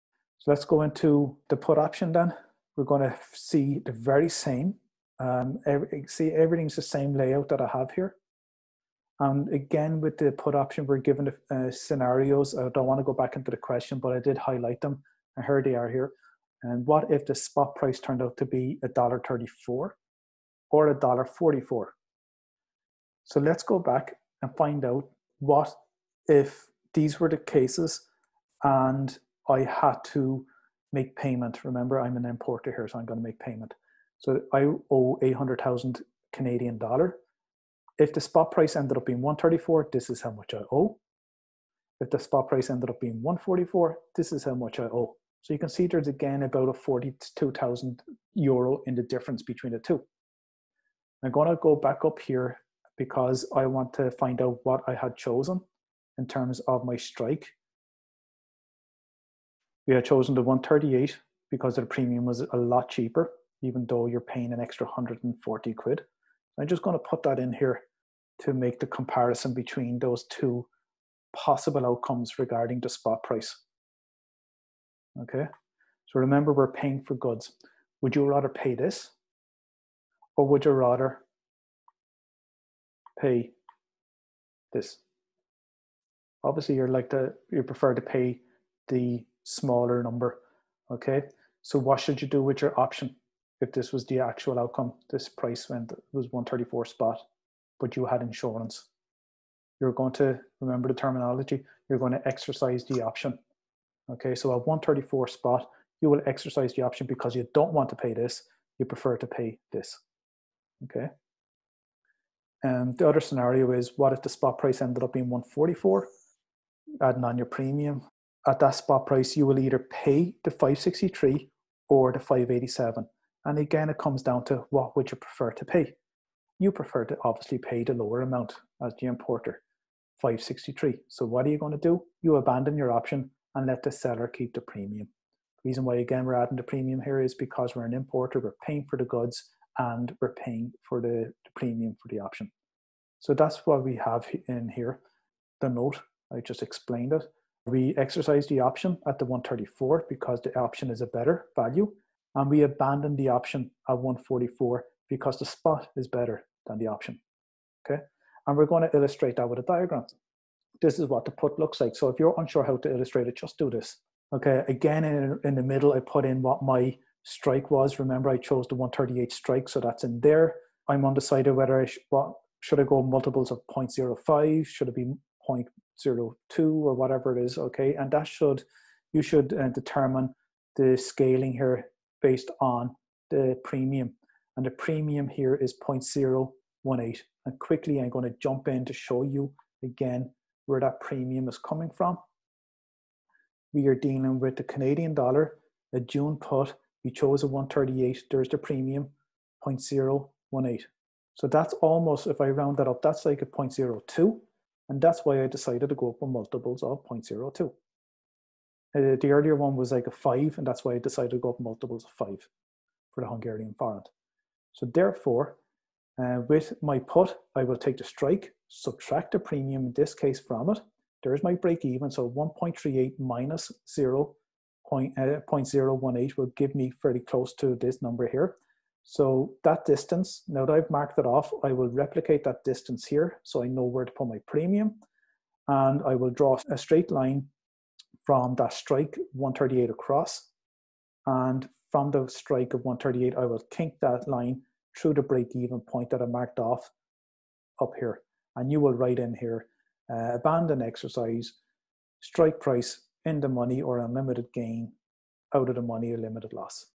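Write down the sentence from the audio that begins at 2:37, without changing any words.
Okay, and we're going to illustrate that with a diagram.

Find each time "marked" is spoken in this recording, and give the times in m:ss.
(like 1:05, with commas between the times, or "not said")
3:50, 4:06.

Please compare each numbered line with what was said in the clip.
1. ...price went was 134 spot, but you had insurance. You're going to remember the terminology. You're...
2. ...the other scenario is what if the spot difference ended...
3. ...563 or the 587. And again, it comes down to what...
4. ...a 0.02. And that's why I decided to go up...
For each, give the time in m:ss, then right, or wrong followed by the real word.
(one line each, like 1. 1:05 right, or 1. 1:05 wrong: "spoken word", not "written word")
1. 1:35 right
2. 1:52 wrong: "price", not "difference"
3. 2:00 right
4. 3:23 right.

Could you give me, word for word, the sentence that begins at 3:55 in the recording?
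And I will draw a straight line from that strike 138 across.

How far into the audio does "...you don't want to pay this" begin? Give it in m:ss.
1:47.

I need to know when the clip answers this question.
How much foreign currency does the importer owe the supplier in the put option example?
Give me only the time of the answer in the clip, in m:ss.
0:35.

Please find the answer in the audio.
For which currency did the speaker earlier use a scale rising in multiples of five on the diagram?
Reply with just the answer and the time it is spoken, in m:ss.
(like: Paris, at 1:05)
Hungarian forint, at 3:33.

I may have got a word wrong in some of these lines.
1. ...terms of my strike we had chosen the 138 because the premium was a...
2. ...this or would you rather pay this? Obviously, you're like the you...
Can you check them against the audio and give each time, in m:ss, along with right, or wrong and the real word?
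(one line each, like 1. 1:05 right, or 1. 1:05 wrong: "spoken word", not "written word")
1. 0:56 right
2. 1:18 right.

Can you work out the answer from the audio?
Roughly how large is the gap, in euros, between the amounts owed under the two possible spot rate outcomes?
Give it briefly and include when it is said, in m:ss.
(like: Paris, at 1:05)
42,000 euro, at 0:46.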